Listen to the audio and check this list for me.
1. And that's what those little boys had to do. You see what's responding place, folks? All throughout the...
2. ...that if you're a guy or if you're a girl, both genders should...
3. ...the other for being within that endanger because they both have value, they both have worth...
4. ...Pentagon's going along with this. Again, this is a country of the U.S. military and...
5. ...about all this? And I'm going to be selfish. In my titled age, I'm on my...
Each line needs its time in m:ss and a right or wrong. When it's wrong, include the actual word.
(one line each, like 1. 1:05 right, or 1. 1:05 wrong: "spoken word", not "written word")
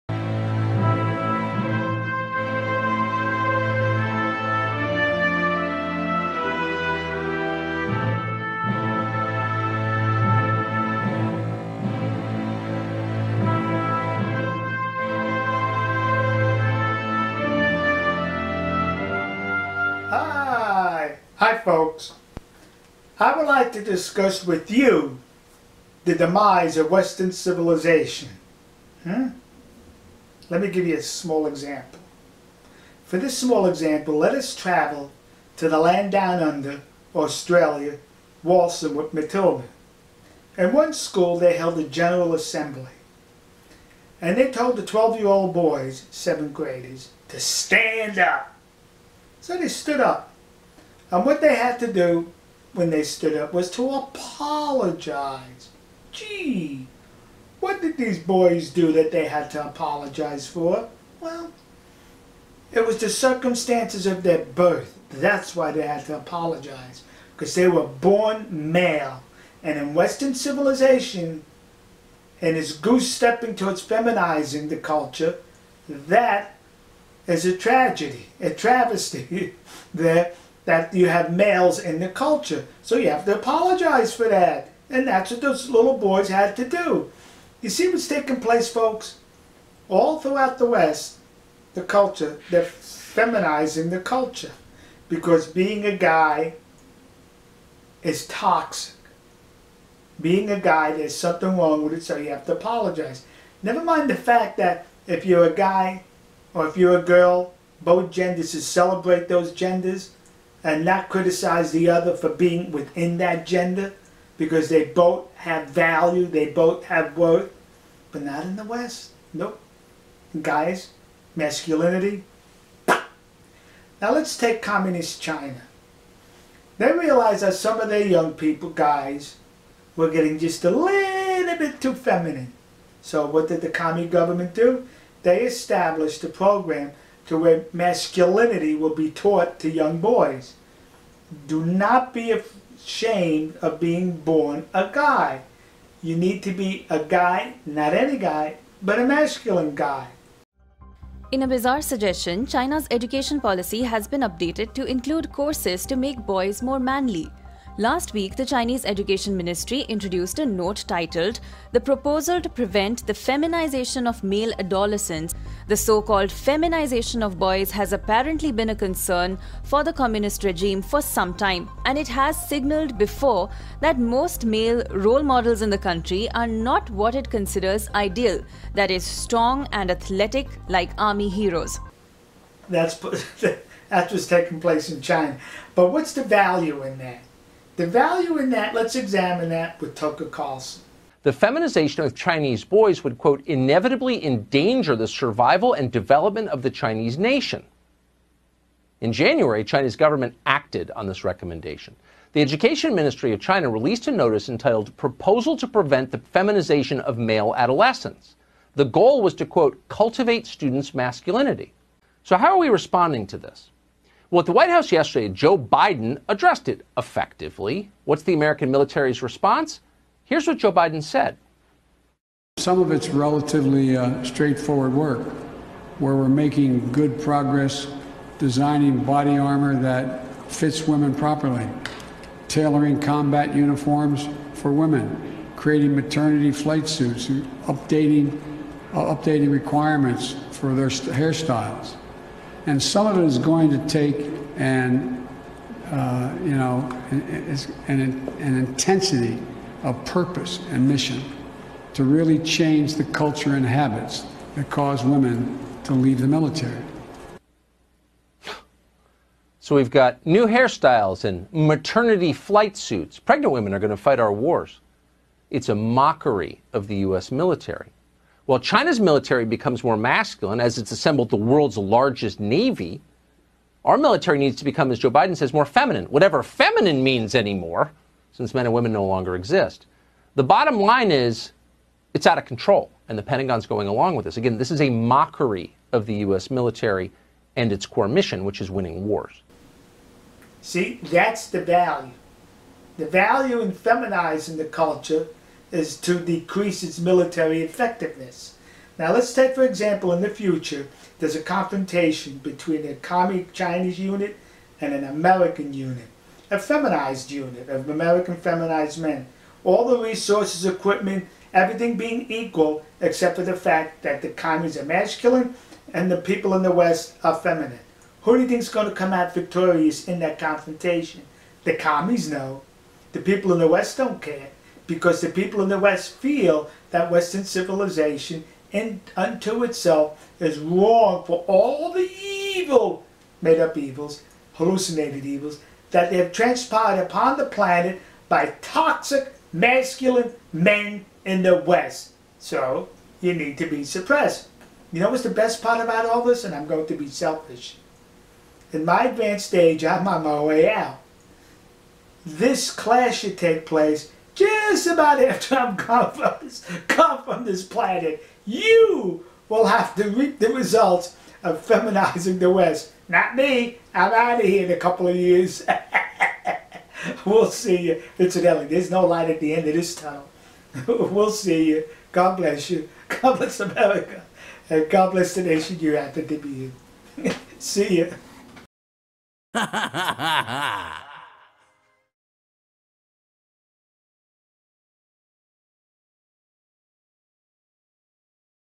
1. 1:24 wrong: "taking", not "responding"
2. 1:44 right
3. 1:51 wrong: "gender", not "endanger"
4. 4:43 wrong: "mockery", not "country"
5. 5:45 wrong: "advanced", not "titled".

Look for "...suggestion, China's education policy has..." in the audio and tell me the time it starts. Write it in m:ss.
2:31.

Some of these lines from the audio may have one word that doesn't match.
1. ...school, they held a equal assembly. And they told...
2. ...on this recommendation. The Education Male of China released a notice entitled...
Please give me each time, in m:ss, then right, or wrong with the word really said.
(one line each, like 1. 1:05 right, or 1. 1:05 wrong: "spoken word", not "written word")
1. 0:40 wrong: "general", not "equal"
2. 3:20 wrong: "Ministry", not "Male".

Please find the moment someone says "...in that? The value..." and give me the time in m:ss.
3:06.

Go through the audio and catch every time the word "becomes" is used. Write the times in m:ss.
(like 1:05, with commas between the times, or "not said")
4:29, 4:34.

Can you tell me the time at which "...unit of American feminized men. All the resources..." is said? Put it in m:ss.
5:07.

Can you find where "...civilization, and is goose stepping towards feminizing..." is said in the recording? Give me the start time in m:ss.
1:10.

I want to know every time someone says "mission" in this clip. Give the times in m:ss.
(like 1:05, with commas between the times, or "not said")
4:10, 4:48.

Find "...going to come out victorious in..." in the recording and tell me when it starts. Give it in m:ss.
5:18.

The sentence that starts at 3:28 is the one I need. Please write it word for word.
The goal was to, quote, cultivate students' masculinity.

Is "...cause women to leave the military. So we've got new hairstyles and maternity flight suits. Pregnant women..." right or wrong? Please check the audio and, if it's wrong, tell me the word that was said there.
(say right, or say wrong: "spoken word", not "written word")
right.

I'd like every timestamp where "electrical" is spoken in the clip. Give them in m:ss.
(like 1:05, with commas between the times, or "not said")
not said.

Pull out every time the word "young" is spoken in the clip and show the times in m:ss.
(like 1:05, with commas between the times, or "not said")
2:08, 2:19.